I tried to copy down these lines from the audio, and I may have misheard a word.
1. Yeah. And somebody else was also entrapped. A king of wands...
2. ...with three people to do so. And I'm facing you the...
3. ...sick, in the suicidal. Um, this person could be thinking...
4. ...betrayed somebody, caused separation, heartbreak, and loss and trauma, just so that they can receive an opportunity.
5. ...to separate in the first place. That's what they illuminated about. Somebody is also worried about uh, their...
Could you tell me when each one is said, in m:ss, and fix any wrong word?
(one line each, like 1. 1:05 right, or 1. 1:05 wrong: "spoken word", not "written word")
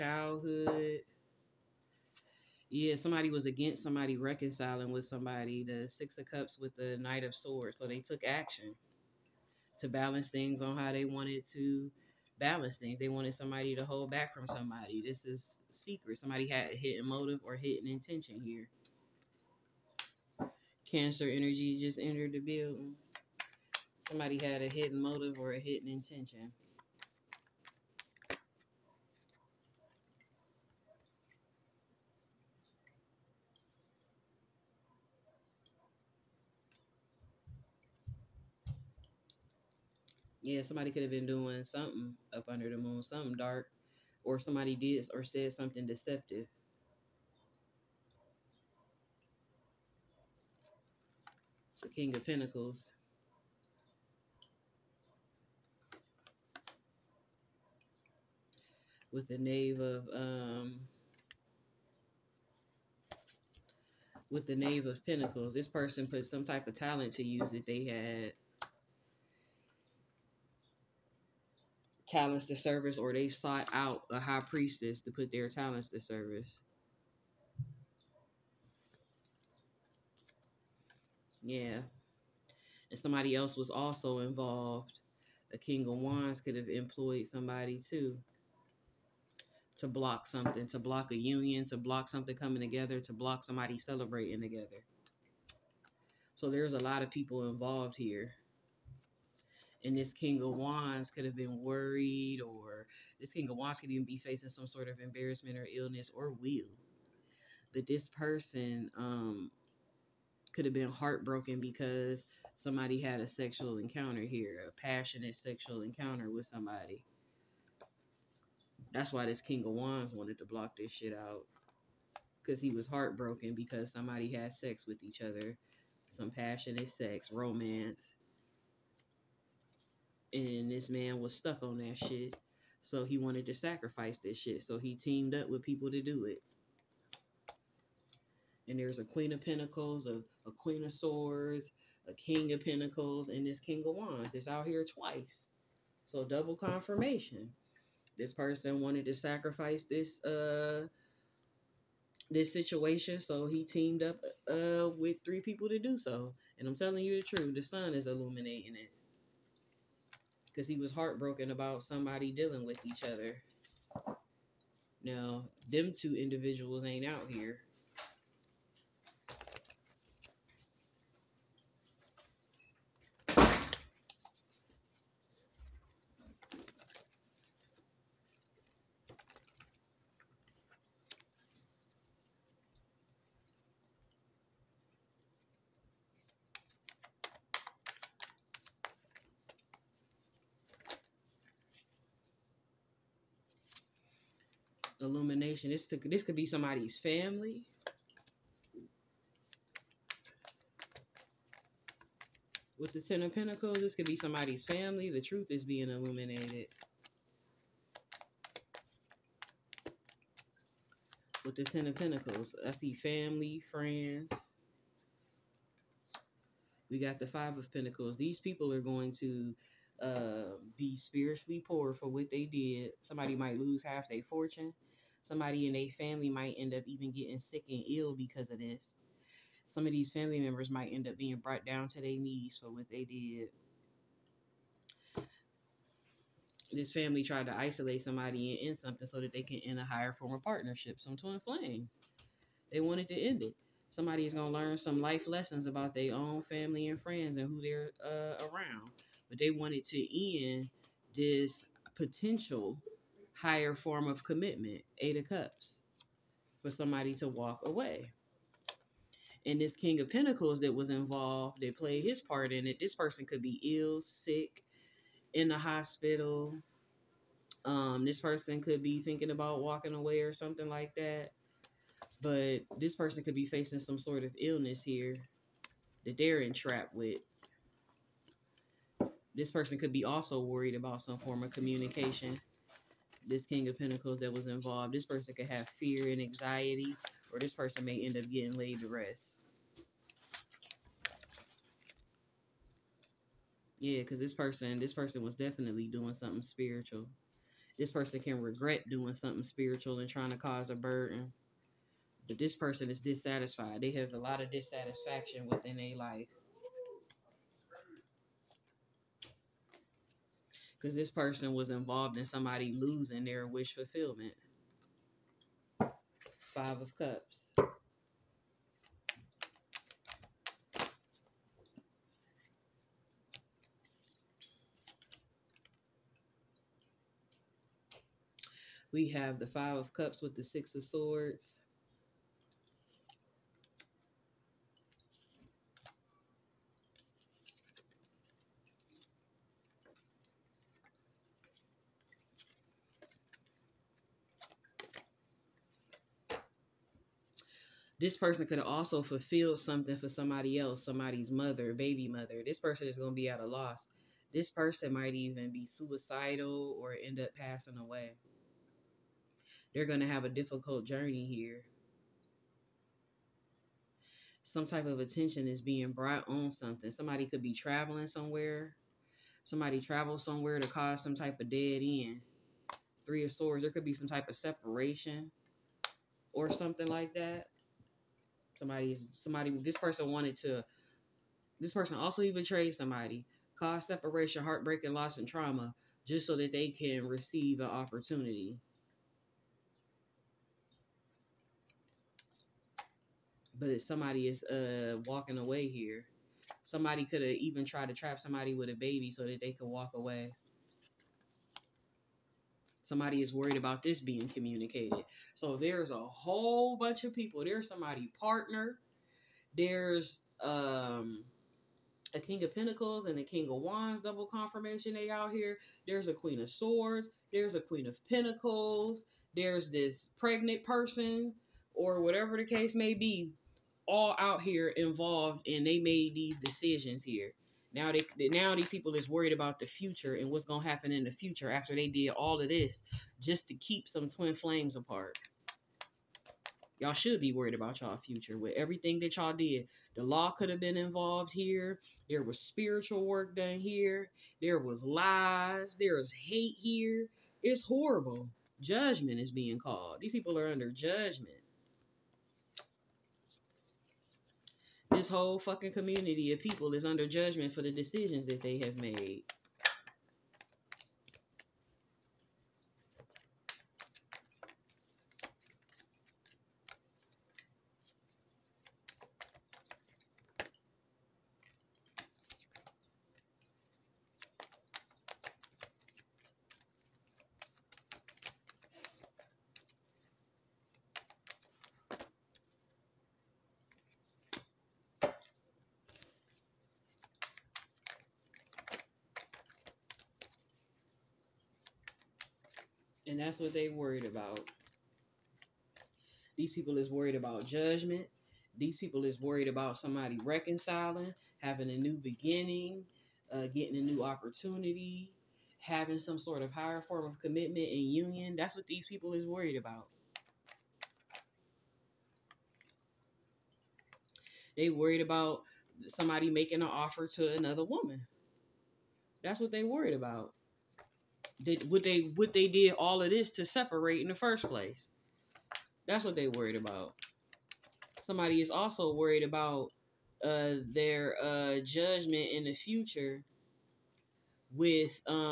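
1. 1:21 wrong: "involved", not "entrapped"
2. 2:34 wrong: "telling", not "facing"
3. 4:24 wrong: "hospital", not "suicidal"
4. 6:22 right
5. 8:43 wrong: "worried", not "illuminated".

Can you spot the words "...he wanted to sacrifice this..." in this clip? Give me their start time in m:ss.
2:13.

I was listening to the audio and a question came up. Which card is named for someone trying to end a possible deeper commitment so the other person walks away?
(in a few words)
Eight of Cups.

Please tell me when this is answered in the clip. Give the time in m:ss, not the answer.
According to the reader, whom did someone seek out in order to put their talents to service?
1:14.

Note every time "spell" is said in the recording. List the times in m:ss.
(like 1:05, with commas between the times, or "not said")
not said.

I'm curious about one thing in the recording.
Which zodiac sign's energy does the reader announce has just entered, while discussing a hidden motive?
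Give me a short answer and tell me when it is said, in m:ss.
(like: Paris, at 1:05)
Cancer, at 0:20.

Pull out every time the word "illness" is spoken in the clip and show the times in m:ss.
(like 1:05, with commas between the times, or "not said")
1:45, 4:34.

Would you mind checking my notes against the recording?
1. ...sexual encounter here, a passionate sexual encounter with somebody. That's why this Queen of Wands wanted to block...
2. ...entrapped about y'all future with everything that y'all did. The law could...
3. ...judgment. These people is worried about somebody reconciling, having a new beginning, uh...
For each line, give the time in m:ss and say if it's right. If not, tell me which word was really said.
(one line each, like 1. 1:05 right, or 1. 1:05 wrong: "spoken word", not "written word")
1. 1:53 wrong: "King", not "Queen"
2. 7:17 wrong: "worried", not "entrapped"
3. 8:17 right.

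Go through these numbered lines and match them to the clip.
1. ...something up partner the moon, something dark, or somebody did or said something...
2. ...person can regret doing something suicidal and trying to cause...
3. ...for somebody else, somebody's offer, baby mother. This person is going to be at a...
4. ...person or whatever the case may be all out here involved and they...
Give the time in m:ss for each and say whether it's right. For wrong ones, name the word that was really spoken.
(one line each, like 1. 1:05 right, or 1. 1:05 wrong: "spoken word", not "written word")
1. 0:41 wrong: "under", not "partner"
2. 4:57 wrong: "spiritual", not "suicidal"
3. 5:49 wrong: "mother", not "offer"
4. 7:00 right.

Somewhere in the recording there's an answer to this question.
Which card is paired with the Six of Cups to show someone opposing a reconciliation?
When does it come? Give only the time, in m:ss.
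0:06.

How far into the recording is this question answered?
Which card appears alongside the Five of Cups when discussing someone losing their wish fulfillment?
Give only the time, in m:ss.
5:30.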